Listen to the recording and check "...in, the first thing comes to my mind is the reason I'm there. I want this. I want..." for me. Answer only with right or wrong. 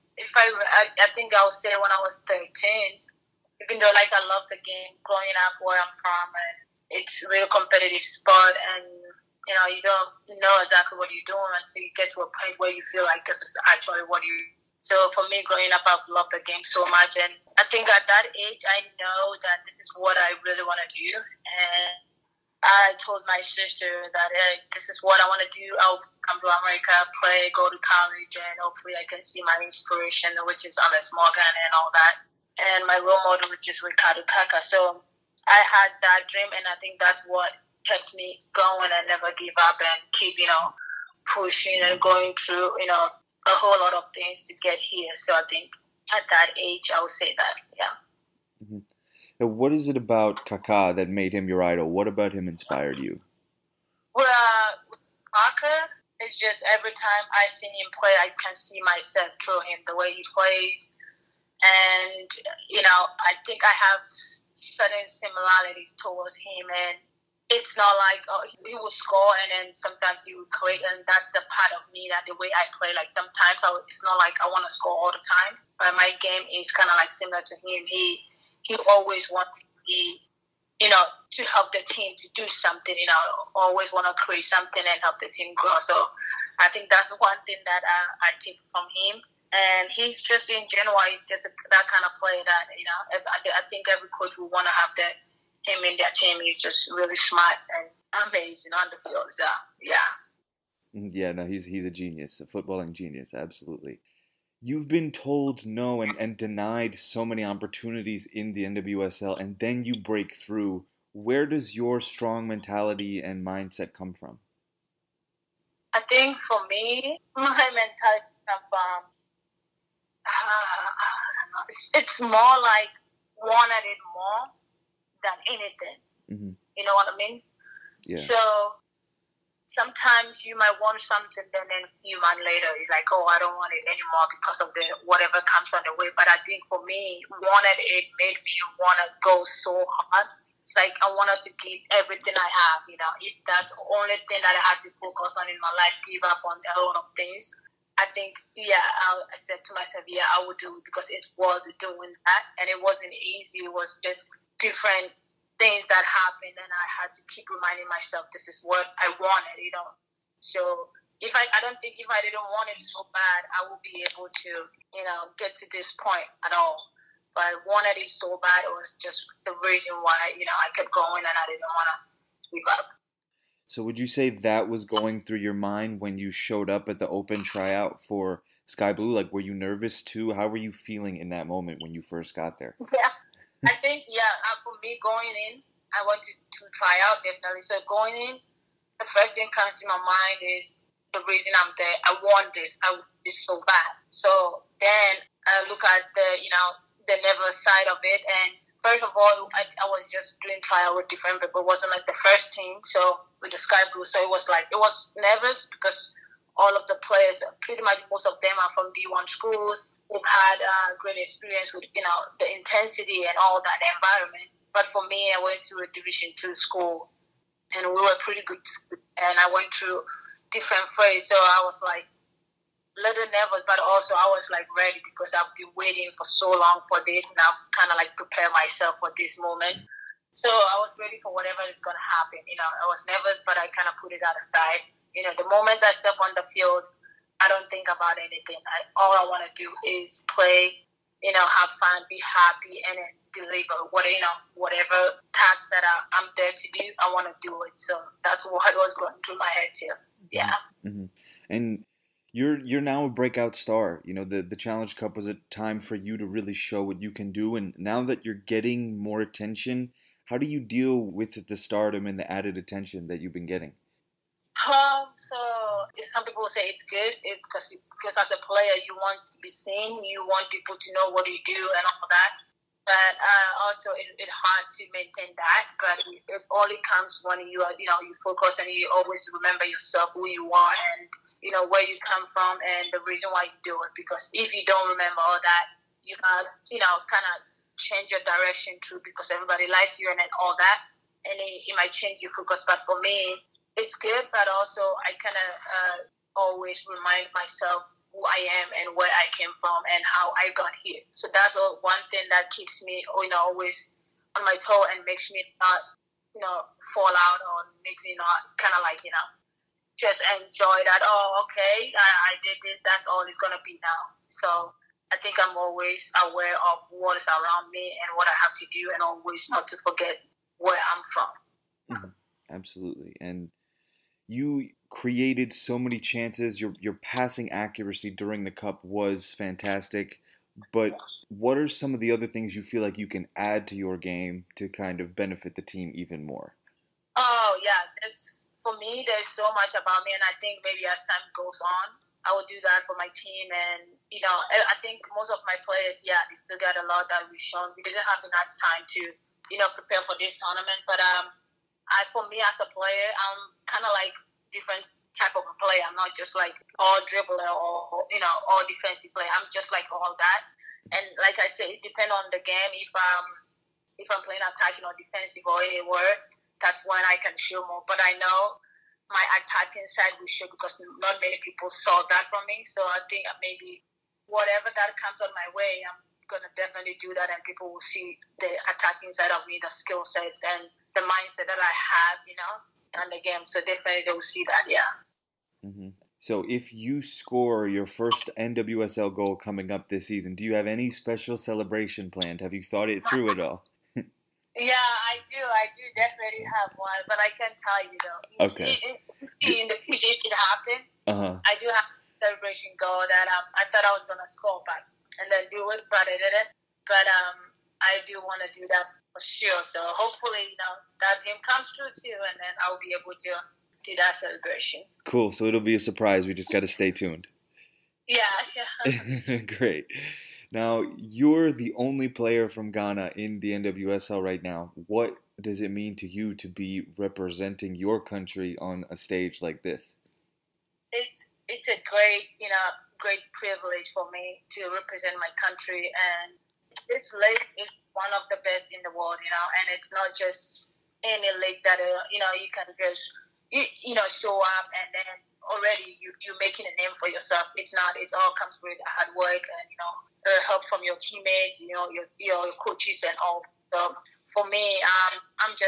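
right.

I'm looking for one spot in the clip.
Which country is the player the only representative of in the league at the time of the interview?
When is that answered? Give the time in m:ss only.
7:02.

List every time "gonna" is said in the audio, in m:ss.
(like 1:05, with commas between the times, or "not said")
5:13, 6:44.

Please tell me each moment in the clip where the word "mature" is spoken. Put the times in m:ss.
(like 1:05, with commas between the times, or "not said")
not said.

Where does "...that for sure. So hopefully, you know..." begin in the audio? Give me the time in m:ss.
6:48.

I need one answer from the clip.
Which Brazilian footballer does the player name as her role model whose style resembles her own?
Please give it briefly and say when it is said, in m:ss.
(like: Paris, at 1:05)
Ricardo Kaka, at 0:33.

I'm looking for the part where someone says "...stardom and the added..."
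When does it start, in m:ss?
4:21.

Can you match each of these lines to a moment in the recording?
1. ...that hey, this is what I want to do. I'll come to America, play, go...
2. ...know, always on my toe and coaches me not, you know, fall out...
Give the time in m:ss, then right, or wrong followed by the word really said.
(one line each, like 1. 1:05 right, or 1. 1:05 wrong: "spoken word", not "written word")
1. 0:24 right
2. 5:03 wrong: "makes", not "coaches".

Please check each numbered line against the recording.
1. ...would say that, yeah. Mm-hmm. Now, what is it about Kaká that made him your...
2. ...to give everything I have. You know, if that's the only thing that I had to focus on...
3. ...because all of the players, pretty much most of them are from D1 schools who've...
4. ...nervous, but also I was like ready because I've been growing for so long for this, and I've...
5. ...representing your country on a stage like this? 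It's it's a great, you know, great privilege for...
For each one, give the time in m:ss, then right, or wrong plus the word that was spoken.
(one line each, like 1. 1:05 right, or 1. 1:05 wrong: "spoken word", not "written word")
1. 0:47 right
2. 2:21 right
3. 3:25 right
4. 3:43 wrong: "waiting", not "growing"
5. 7:06 right.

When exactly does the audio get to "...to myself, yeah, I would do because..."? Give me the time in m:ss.
2:29.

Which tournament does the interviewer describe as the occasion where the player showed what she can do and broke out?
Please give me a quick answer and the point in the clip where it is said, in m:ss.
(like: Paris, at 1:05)
Challenge Cup, at 4:14.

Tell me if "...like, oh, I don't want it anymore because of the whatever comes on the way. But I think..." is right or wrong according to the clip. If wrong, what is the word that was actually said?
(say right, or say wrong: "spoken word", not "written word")
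right.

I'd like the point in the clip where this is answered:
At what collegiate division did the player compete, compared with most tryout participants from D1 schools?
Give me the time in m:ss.
3:35.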